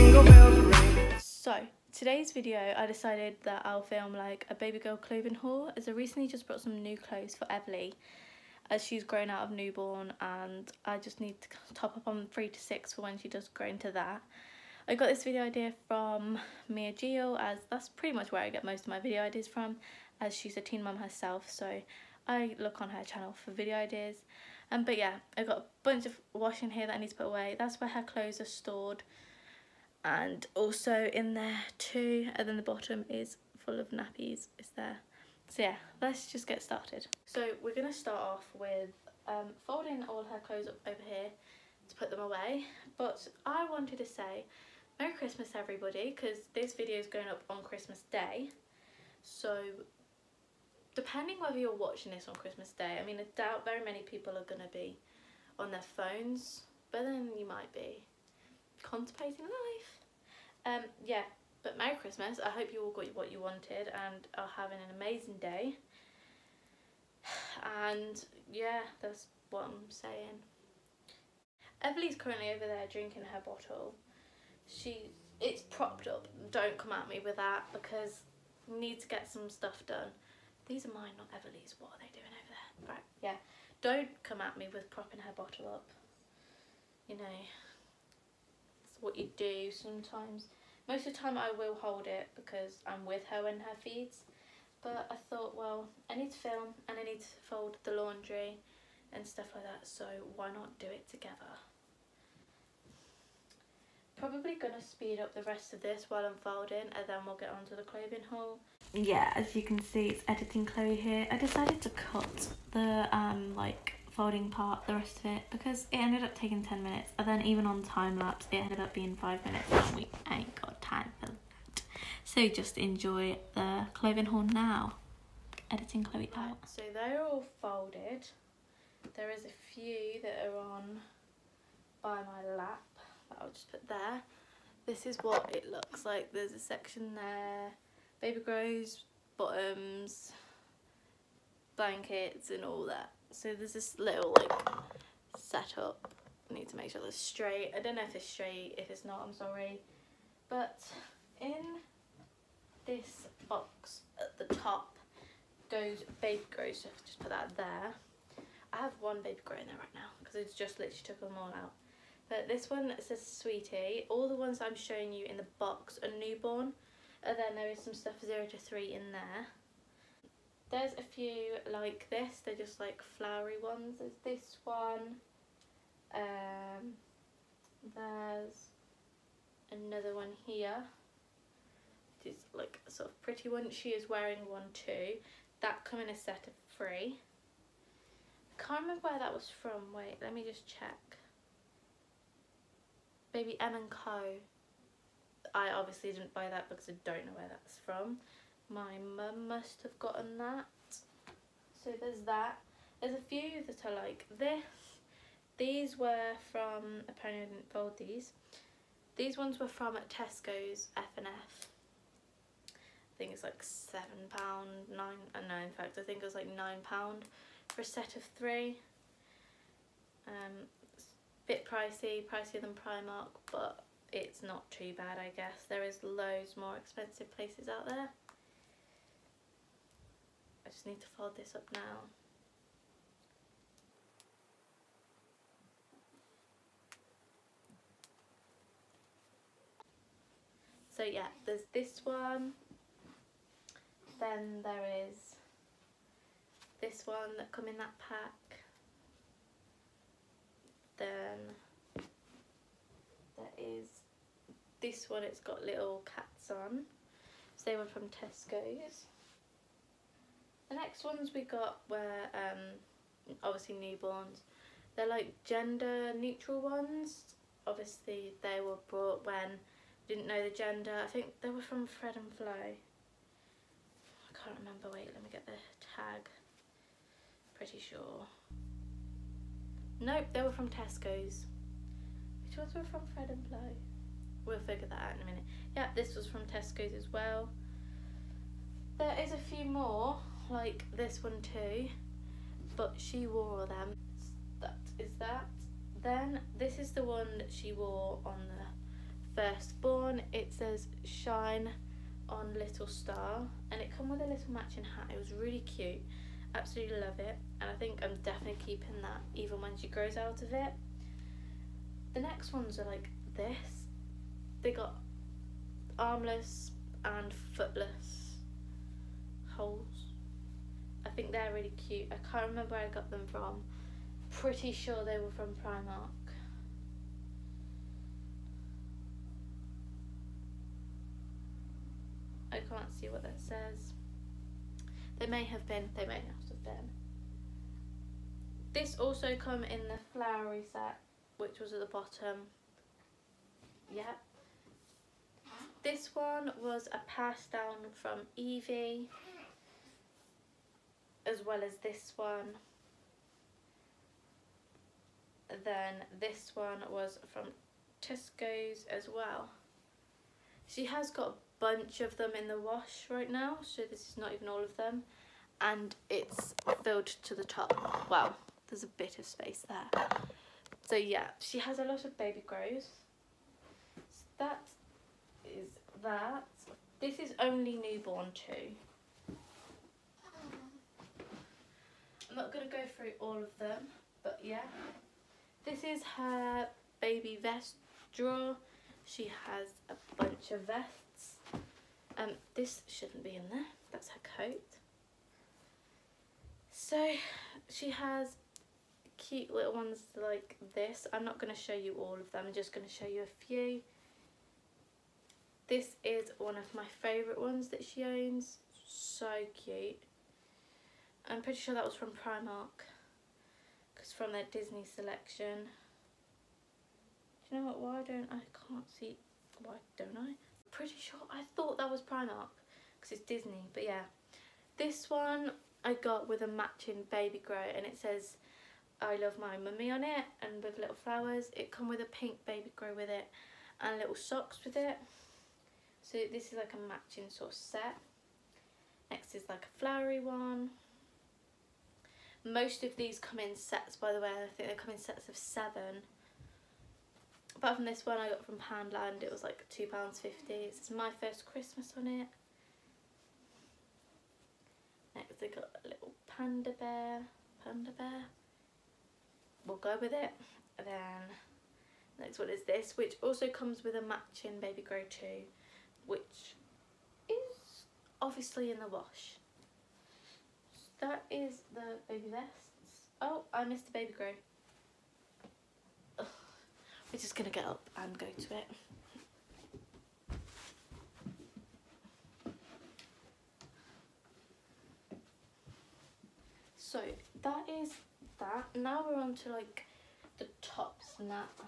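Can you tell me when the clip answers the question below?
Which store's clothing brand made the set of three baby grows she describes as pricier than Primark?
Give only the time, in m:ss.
3:30.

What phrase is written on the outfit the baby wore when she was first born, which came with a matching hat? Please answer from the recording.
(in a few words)
Shine on little star.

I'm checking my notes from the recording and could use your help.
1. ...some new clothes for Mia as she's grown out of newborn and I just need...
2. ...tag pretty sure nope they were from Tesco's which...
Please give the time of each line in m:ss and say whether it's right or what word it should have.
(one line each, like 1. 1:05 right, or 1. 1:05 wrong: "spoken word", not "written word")
1. 0:06 wrong: "Everly", not "Mia"
2. 4:35 right.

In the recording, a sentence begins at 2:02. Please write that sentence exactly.
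So just enjoy the clothing horn now.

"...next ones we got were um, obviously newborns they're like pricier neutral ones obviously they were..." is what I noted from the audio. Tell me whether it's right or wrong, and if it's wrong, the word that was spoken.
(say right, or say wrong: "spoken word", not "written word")
wrong: "gender", not "pricier".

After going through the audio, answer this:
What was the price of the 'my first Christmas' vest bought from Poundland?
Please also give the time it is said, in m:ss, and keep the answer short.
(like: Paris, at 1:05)
£2.50, at 7:29.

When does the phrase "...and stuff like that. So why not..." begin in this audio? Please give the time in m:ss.
1:39.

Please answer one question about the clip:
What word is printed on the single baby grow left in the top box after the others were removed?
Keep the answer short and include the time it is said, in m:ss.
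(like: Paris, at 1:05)
Sweetie, at 2:43.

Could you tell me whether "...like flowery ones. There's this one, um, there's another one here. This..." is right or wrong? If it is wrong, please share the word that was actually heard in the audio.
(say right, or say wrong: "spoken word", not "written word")
right.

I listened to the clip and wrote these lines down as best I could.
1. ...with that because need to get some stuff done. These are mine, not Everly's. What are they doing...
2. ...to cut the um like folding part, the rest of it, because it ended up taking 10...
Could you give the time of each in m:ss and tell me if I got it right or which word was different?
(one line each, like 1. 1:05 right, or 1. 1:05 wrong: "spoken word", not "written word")
1. 1:17 right
2. 1:51 right.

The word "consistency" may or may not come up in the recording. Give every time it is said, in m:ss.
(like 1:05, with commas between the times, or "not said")
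not said.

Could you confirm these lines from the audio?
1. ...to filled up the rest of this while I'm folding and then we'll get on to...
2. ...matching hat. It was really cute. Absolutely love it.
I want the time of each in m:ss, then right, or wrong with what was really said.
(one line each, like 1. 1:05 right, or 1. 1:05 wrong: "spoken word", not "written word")
1. 1:44 wrong: "speed", not "filled"
2. 5:04 right.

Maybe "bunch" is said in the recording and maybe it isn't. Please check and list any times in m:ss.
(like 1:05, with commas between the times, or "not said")
0:25, 6:01, 6:30.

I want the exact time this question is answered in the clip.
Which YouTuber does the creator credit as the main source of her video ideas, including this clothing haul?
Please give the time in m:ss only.
0:16.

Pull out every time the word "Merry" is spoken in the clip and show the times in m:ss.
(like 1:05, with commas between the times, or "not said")
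0:44, 1:01.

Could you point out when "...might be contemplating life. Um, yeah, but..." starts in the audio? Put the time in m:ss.
0:57.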